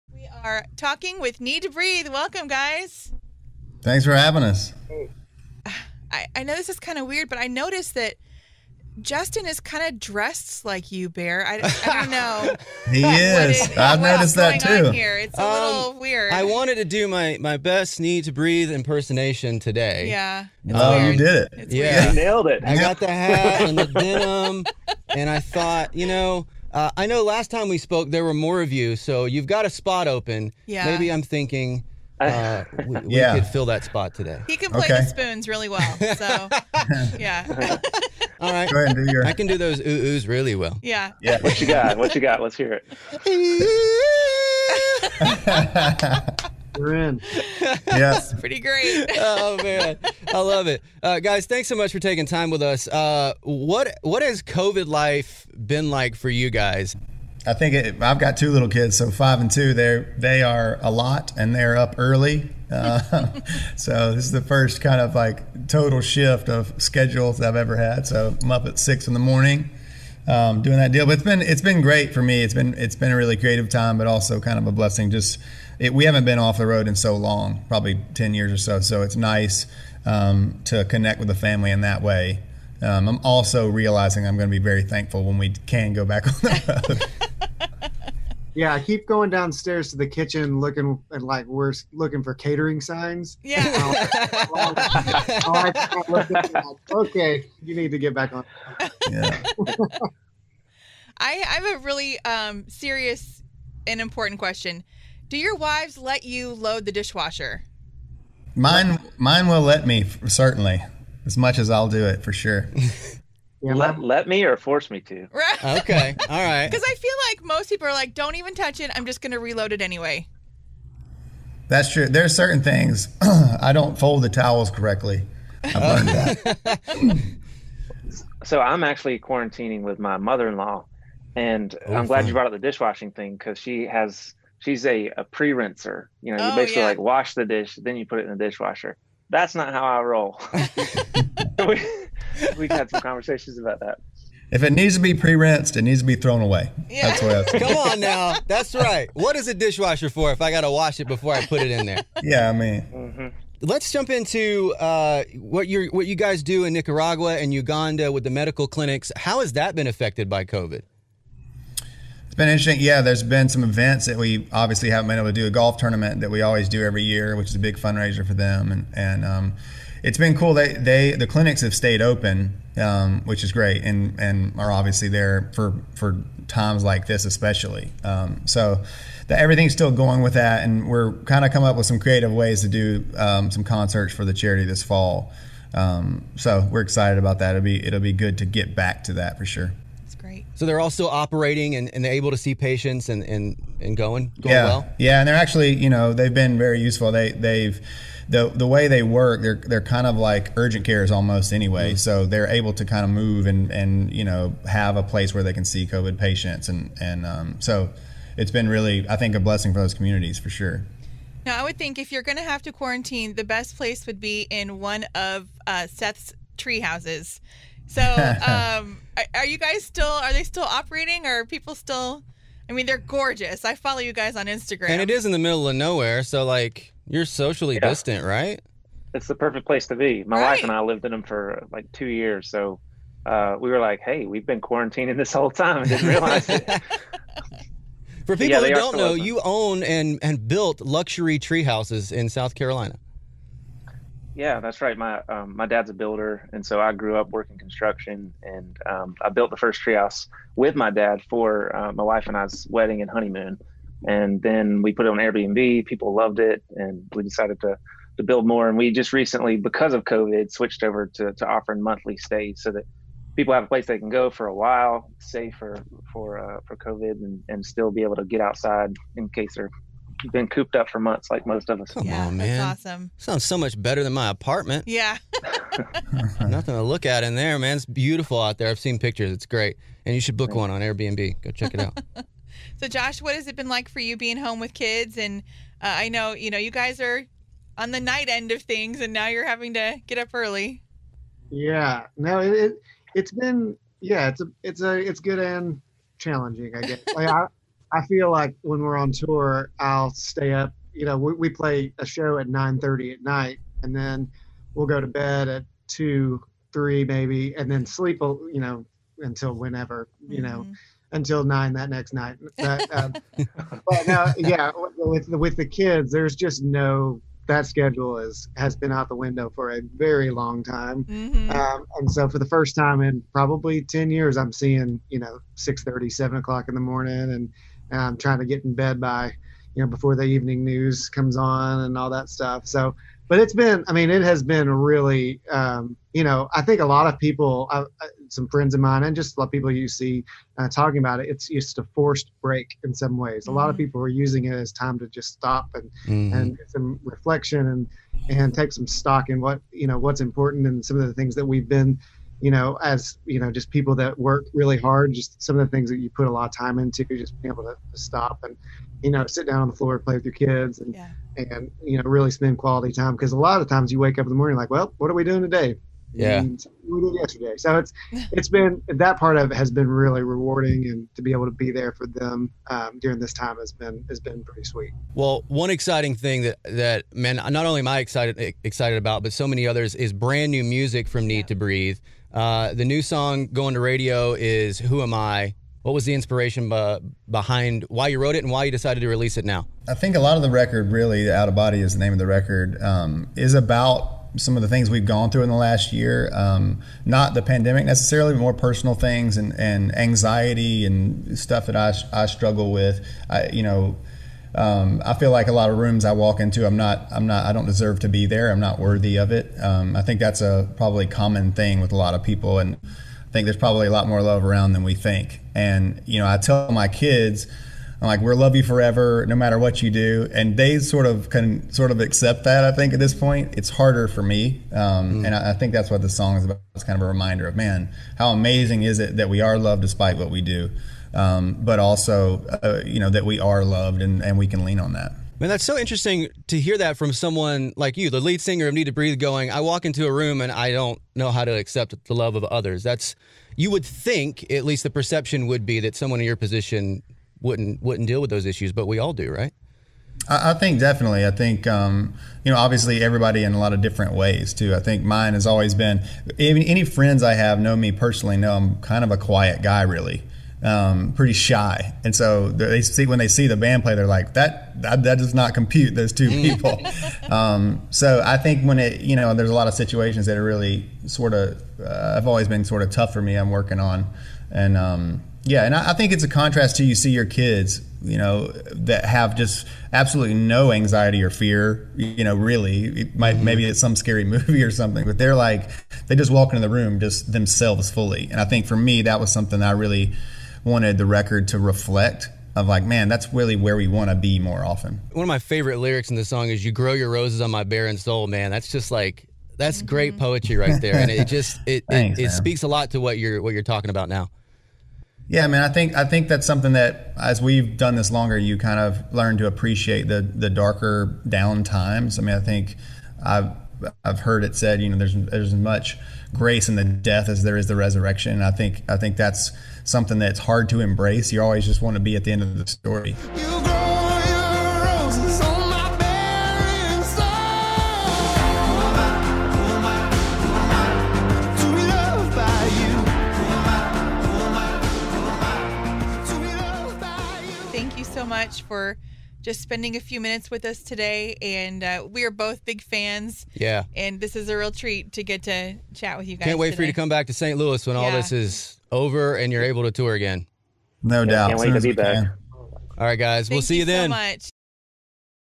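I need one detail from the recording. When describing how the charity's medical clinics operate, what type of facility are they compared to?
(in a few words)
Urgent cares.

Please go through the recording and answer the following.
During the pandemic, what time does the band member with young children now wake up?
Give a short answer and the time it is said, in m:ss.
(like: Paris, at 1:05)
6 in the morning, at 1:08.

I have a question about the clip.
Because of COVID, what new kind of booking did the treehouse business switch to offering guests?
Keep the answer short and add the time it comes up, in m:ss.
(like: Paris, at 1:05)
Monthly stays, at 4:21.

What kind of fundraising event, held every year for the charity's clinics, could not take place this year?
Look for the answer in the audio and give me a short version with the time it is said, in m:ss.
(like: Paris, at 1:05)
A golf tournament, at 2:45.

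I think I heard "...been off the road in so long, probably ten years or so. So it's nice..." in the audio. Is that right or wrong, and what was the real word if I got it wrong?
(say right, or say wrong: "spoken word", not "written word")
right.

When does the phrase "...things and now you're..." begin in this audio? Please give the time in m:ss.
4:48.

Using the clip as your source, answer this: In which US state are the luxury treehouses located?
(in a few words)
South Carolina.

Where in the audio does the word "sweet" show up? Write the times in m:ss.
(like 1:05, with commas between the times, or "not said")
6:14.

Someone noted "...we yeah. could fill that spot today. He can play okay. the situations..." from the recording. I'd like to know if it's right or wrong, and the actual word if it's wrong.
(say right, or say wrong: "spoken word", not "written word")
wrong: "spoons", not "situations".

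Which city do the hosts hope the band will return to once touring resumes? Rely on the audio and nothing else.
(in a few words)
St. Louis.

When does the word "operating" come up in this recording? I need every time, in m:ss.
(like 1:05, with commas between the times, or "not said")
3:11, 3:40.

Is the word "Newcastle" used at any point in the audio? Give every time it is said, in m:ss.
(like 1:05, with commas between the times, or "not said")
not said.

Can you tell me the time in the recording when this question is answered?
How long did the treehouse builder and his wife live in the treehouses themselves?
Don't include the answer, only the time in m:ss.
3:51.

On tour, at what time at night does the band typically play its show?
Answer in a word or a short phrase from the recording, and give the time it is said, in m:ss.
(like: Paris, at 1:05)
9:30, at 5:02.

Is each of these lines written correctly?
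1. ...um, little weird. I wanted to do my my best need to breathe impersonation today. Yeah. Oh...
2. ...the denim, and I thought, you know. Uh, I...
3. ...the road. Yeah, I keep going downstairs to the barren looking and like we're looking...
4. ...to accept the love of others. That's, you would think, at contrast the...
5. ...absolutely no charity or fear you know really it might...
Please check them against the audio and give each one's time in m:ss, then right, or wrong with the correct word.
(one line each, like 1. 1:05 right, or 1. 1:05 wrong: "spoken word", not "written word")
1. 0:15 right
2. 0:23 right
3. 1:26 wrong: "kitchen", not "barren"
4. 7:21 wrong: "least", not "contrast"
5. 7:59 wrong: "anxiety", not "charity".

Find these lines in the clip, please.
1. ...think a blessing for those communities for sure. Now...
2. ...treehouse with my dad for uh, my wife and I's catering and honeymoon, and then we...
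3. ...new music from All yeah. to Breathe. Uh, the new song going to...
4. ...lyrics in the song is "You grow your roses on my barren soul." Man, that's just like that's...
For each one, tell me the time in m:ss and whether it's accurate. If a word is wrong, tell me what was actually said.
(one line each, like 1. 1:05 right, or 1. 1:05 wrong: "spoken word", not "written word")
1. 3:29 right
2. 4:09 wrong: "wedding", not "catering"
3. 6:20 wrong: "Need", not "All"
4. 8:15 right.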